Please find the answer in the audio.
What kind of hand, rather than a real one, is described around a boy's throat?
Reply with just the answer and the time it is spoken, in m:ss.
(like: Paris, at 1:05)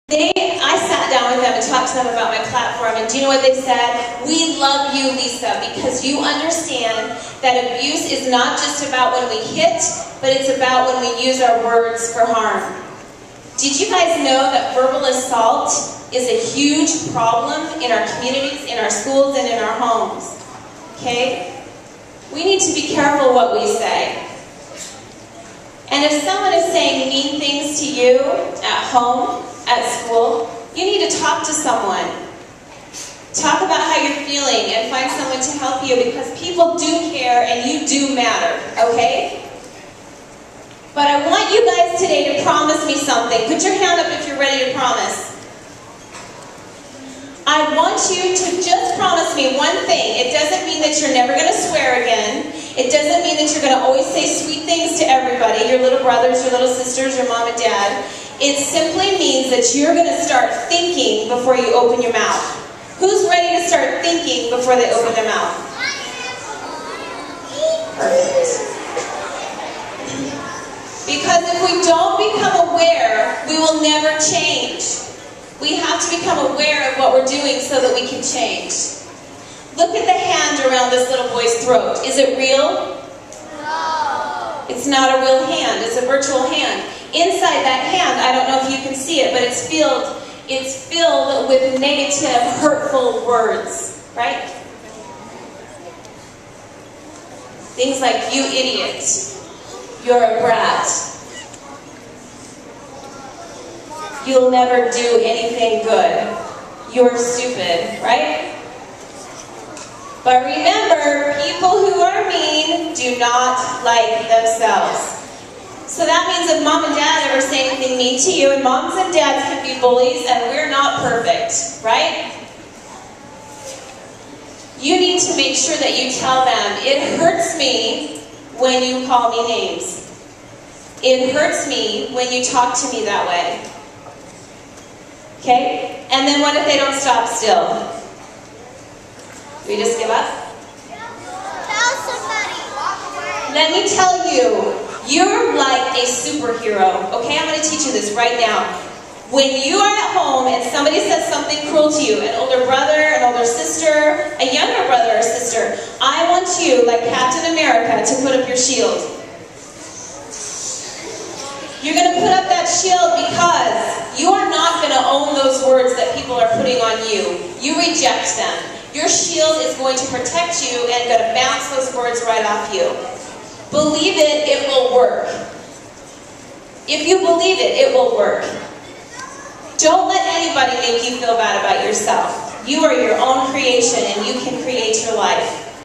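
Virtual, at 1:26.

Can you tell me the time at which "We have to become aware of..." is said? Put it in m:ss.
1:15.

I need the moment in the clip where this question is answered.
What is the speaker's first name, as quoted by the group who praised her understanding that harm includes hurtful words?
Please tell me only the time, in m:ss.
0:05.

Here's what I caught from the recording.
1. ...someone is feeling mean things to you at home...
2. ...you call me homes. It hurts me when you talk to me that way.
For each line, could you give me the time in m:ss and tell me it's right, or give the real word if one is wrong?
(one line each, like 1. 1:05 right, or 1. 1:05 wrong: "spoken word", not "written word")
1. 0:26 wrong: "saying", not "feeling"
2. 2:08 wrong: "names", not "homes".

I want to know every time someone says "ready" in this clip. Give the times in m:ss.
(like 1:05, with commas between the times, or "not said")
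0:44, 1:03.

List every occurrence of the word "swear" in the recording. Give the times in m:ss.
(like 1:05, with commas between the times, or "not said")
0:51.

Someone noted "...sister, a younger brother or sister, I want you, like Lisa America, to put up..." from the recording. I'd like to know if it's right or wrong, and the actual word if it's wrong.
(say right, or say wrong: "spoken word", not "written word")
wrong: "Captain", not "Lisa".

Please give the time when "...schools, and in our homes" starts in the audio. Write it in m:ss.
0:18.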